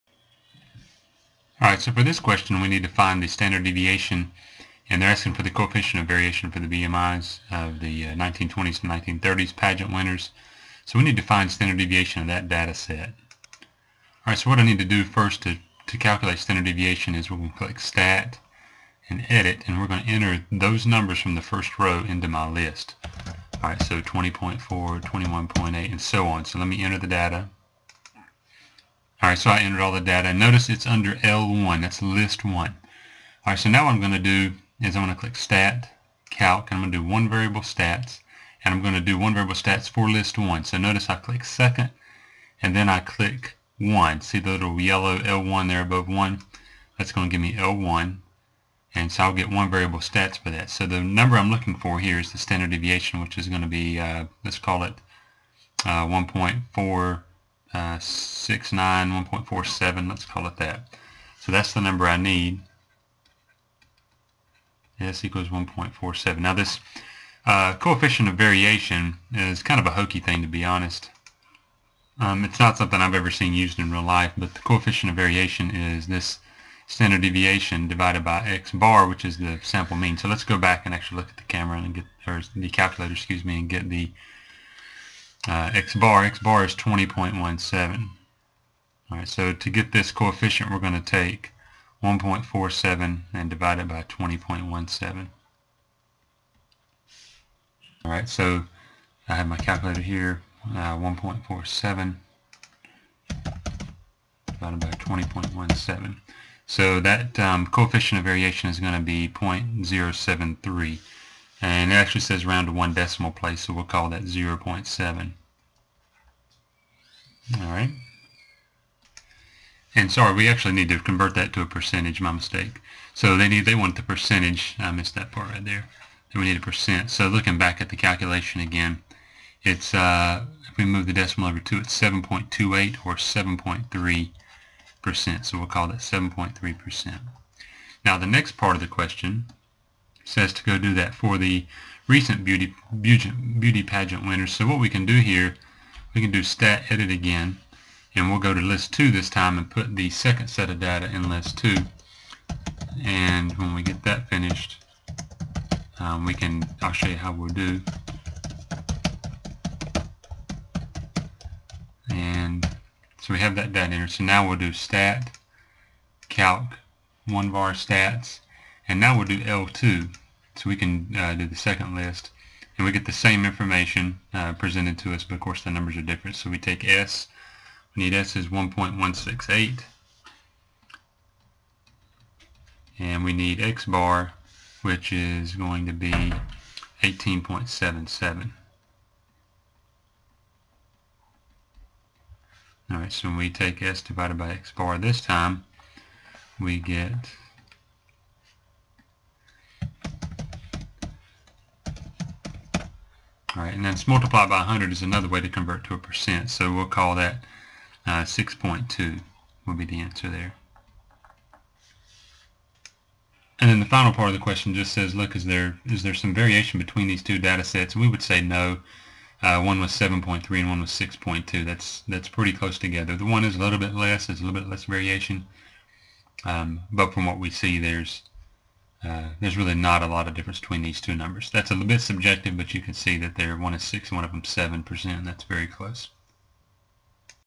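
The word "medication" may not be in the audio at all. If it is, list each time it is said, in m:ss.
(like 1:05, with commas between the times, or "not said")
not said.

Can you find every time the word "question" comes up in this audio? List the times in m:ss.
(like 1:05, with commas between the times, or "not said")
0:02, 2:18, 3:34.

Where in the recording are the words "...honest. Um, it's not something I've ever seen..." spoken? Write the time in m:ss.
1:10.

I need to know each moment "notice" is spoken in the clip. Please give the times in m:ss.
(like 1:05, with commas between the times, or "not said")
0:30, 0:40.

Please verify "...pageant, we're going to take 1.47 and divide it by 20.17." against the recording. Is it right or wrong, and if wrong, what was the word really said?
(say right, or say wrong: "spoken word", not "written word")
wrong: "coefficient", not "pageant".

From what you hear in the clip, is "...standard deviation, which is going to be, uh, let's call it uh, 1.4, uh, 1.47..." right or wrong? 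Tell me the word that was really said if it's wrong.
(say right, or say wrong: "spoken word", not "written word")
right.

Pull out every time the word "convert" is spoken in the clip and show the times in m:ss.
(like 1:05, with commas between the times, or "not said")
2:00, 3:25.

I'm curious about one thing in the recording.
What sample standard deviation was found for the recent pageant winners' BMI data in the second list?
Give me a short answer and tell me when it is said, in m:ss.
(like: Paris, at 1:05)
1.168, at 2:58.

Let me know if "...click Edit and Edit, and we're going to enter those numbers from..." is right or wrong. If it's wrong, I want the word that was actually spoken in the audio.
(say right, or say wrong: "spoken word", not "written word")
wrong: "Stat", not "Edit".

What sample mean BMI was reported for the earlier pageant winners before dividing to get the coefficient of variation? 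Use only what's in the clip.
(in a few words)
20.17.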